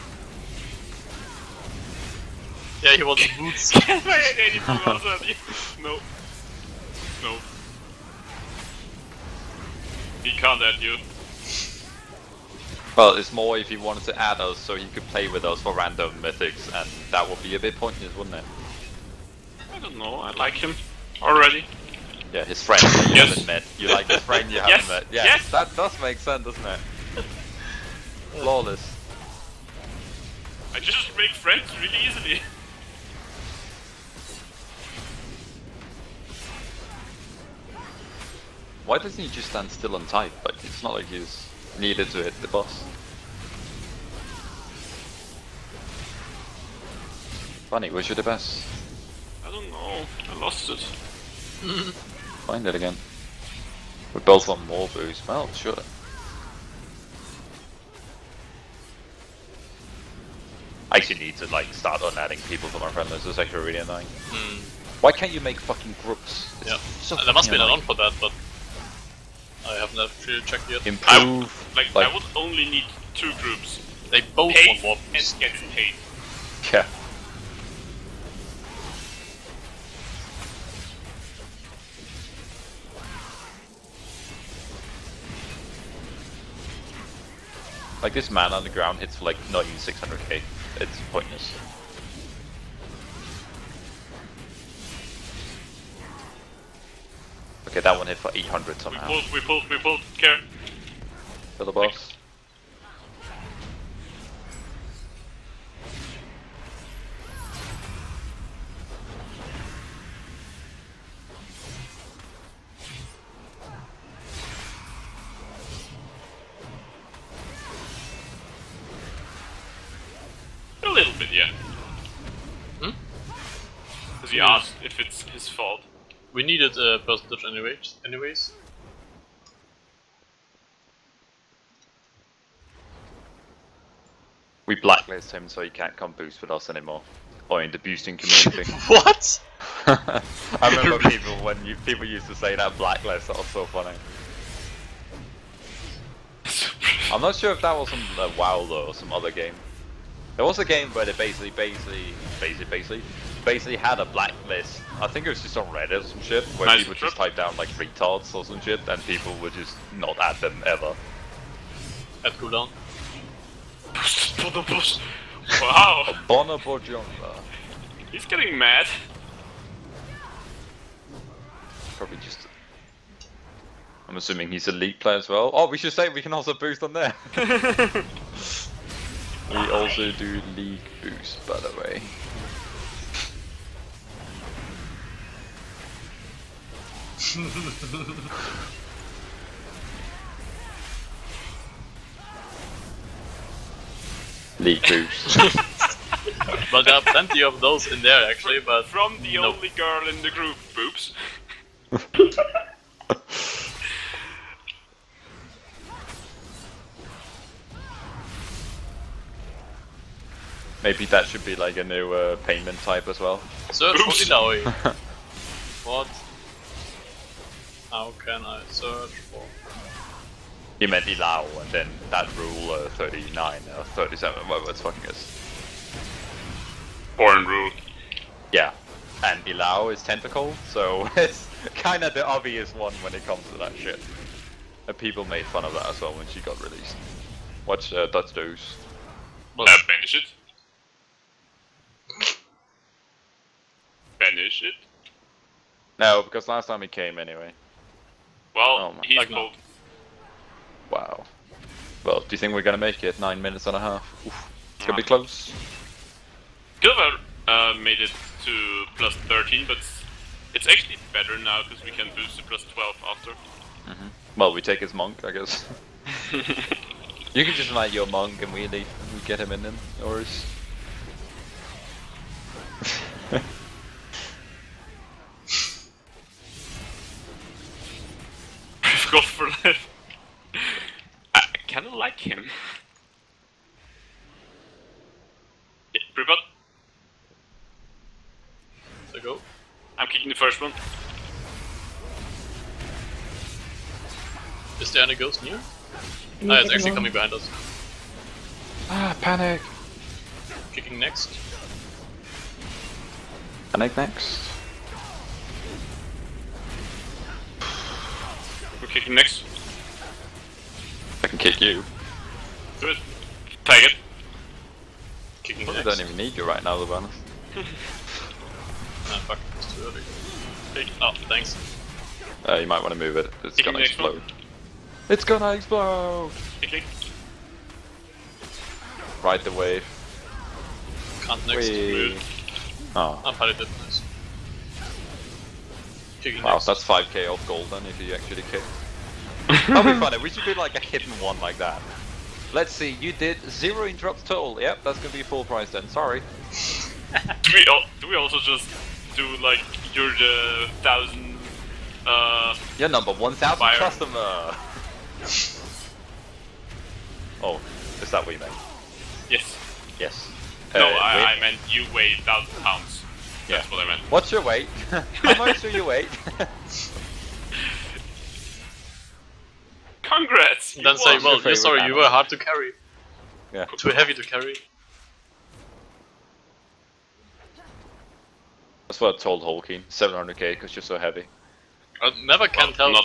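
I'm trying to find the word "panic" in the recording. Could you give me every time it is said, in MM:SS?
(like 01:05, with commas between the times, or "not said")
04:59, 05:03.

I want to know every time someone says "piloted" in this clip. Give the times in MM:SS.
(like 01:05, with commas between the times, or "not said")
05:33.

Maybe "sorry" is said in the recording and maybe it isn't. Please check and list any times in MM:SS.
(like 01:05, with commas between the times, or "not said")
05:45, 06:11.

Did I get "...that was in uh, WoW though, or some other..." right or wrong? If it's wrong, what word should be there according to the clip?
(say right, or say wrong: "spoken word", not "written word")
right.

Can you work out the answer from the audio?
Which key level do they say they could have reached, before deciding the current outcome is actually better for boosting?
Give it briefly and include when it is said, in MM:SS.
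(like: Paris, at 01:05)
plus 13, at 04:18.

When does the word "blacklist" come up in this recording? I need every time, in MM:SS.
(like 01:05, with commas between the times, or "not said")
02:14, 02:22, 02:34.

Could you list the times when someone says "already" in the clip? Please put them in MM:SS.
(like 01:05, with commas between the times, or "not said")
00:05, 00:21.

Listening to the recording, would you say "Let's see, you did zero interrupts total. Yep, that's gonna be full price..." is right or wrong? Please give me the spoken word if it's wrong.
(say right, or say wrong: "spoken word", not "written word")
right.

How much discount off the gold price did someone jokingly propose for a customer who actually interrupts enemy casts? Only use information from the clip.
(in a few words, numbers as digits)
5k.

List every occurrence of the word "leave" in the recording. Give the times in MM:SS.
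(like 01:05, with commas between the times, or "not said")
04:28.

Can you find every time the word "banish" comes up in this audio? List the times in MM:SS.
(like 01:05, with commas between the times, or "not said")
03:59, 04:04.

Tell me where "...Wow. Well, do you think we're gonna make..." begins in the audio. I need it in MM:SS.
04:10.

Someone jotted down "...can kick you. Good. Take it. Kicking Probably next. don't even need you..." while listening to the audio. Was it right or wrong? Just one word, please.
right.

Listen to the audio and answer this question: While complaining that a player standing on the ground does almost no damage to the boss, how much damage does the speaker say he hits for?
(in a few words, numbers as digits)
not even 600k.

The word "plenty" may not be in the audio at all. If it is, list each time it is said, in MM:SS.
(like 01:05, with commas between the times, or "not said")
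03:17.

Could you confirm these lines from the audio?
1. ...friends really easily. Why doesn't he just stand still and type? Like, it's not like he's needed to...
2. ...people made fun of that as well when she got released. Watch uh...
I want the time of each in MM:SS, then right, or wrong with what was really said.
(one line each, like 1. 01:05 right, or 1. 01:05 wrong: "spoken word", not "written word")
1. 00:31 right
2. 03:54 right.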